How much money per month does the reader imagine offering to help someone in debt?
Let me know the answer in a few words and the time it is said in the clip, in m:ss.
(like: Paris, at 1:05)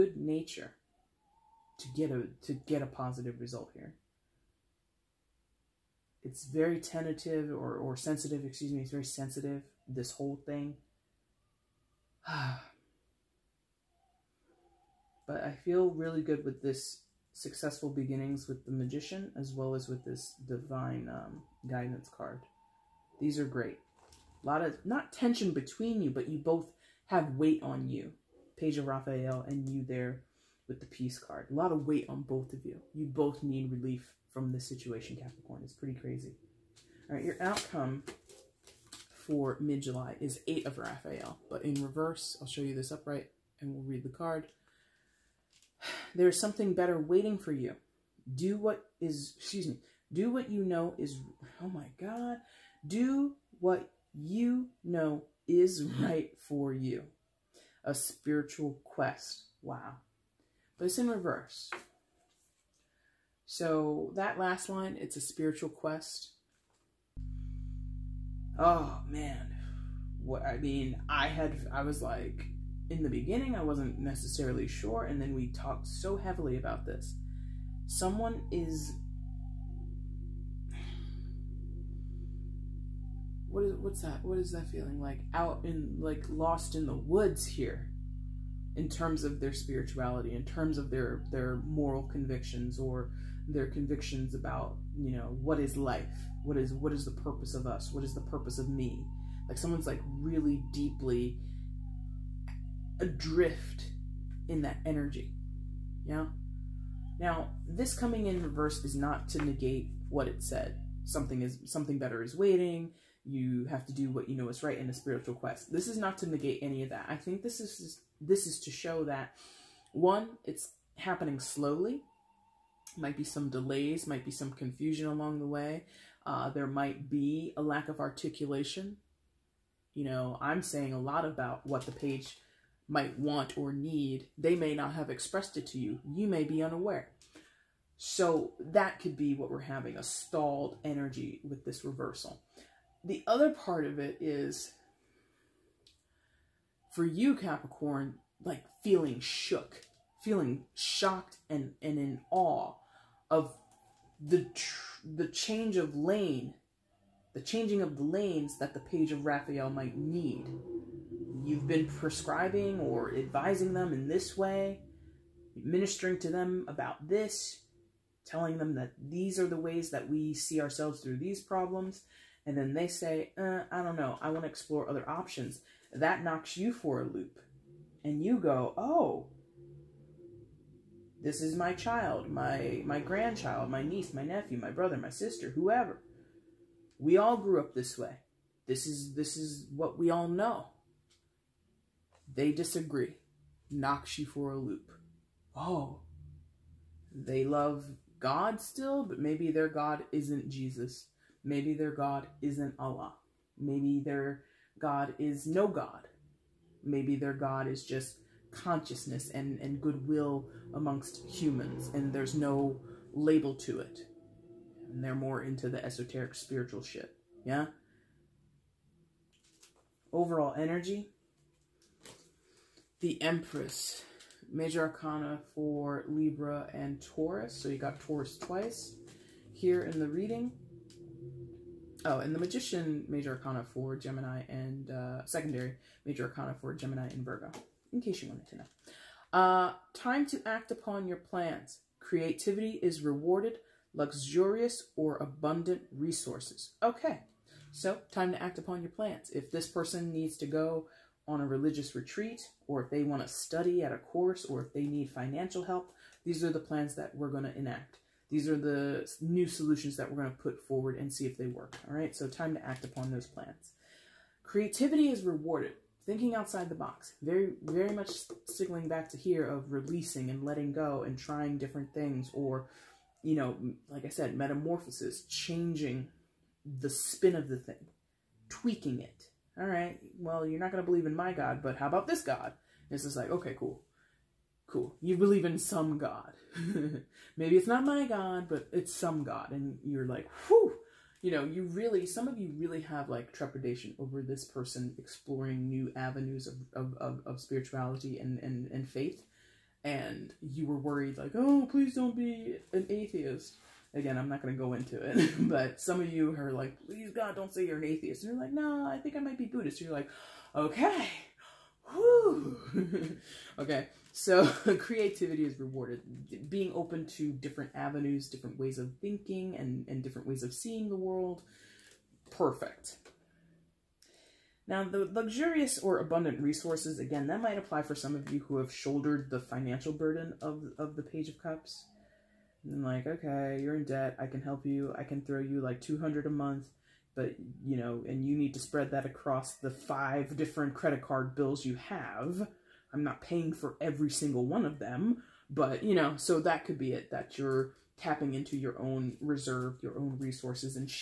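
200, at 5:35.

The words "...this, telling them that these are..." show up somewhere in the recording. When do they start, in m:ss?
2:47.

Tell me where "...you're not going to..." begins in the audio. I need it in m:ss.
4:40.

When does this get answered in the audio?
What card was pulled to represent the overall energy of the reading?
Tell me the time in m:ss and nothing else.
3:42.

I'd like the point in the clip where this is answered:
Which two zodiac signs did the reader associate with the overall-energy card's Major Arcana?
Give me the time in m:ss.
3:46.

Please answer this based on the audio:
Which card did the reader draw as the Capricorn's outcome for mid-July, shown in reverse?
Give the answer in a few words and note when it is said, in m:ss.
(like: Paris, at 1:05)
8 of Raphael, at 0:40.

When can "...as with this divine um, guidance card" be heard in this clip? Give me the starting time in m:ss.
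0:19.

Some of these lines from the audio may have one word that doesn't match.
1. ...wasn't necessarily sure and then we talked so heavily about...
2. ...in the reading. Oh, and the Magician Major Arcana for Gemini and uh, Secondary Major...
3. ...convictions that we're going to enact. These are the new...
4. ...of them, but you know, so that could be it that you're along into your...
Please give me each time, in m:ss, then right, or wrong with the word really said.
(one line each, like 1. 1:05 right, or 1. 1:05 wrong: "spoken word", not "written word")
1. 1:13 right
2. 3:49 right
3. 4:16 wrong: "plans", not "convictions"
4. 5:44 wrong: "tapping", not "along".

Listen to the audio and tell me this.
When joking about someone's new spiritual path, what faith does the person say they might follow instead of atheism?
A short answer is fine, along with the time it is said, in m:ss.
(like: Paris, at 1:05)
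Buddhist, at 5:09.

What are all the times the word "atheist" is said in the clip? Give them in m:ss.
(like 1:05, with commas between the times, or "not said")
5:02, 5:07.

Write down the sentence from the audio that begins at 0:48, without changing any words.
Do what is, excuse me, do what you know is, oh my God, do what you know is right for you.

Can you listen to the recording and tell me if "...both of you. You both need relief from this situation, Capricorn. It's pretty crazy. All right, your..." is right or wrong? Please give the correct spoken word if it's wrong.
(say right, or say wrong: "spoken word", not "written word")
right.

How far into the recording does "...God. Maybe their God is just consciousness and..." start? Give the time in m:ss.
3:25.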